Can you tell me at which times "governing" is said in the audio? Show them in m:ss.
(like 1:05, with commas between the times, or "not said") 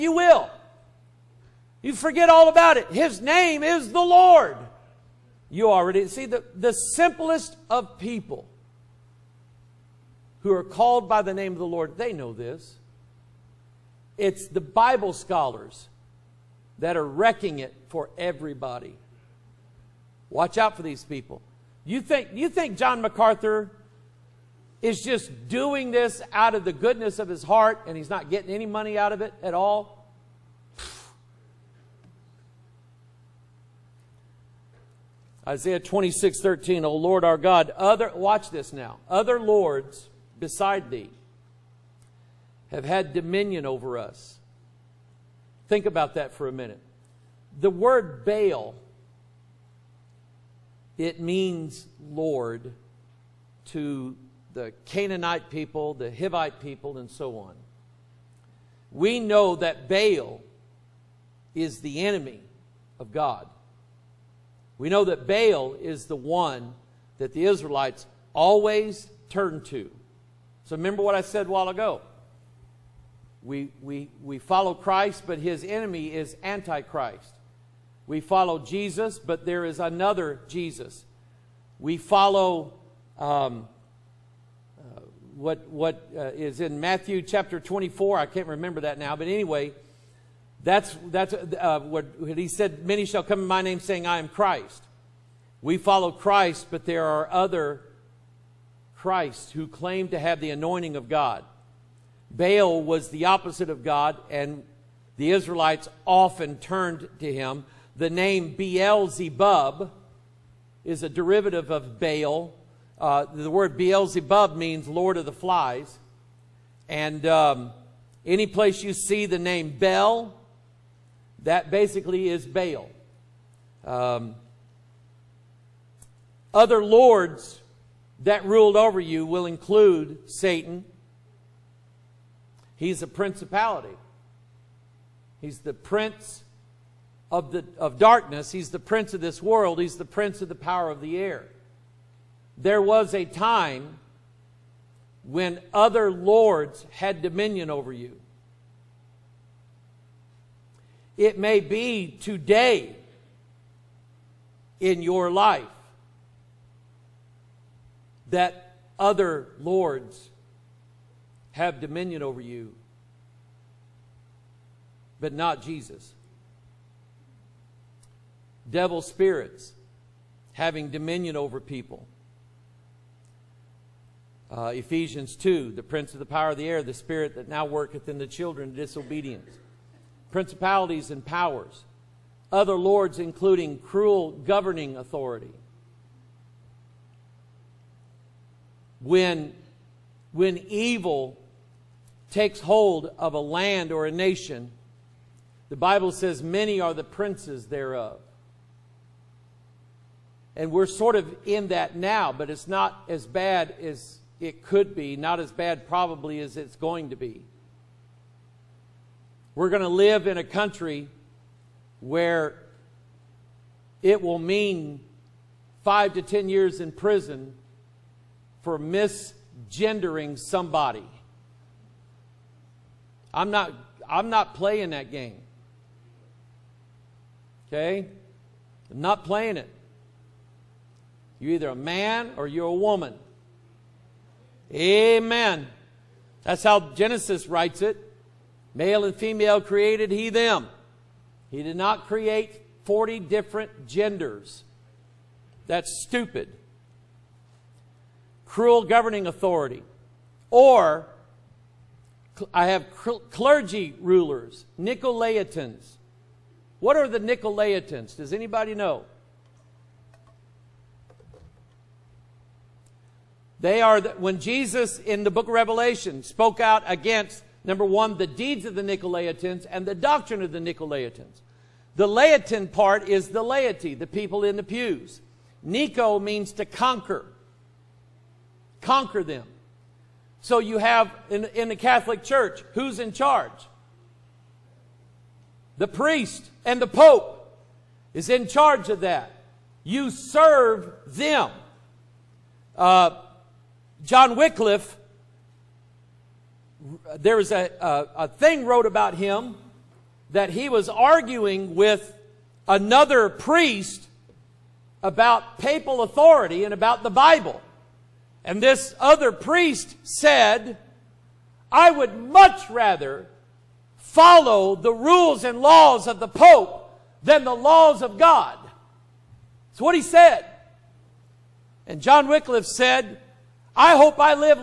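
3:04, 4:08.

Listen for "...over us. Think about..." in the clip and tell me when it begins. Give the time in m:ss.
0:43.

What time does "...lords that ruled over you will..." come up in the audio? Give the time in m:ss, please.
2:06.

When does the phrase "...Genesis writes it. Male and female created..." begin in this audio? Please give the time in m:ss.
3:56.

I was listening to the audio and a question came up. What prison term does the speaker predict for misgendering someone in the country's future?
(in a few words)
5 to 10 years.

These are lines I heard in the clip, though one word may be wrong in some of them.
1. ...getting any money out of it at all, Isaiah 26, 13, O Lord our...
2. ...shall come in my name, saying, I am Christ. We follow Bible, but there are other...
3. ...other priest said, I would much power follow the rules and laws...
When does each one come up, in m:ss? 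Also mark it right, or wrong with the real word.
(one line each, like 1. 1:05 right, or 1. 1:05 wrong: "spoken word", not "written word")
1. 0:28 right
2. 1:33 wrong: "Christ", not "Bible"
3. 5:08 wrong: "rather", not "power".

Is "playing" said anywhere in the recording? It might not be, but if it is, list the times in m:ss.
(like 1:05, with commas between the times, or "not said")
3:44, 3:49.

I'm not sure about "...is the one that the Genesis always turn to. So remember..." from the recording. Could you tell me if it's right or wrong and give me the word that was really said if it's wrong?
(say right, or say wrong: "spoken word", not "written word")
wrong: "Israelites", not "Genesis".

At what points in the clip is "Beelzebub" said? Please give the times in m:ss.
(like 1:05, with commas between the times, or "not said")
1:48, 1:53.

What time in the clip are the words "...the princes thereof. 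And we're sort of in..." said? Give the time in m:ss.
3:16.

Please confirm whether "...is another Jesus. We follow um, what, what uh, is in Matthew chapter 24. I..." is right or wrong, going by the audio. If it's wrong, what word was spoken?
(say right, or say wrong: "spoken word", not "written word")
right.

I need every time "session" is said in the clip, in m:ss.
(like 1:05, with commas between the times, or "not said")
not said.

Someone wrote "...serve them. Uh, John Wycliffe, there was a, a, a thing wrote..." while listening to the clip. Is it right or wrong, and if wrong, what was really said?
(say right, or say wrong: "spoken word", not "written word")
right.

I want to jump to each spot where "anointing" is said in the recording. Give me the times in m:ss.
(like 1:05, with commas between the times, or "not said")
1:40.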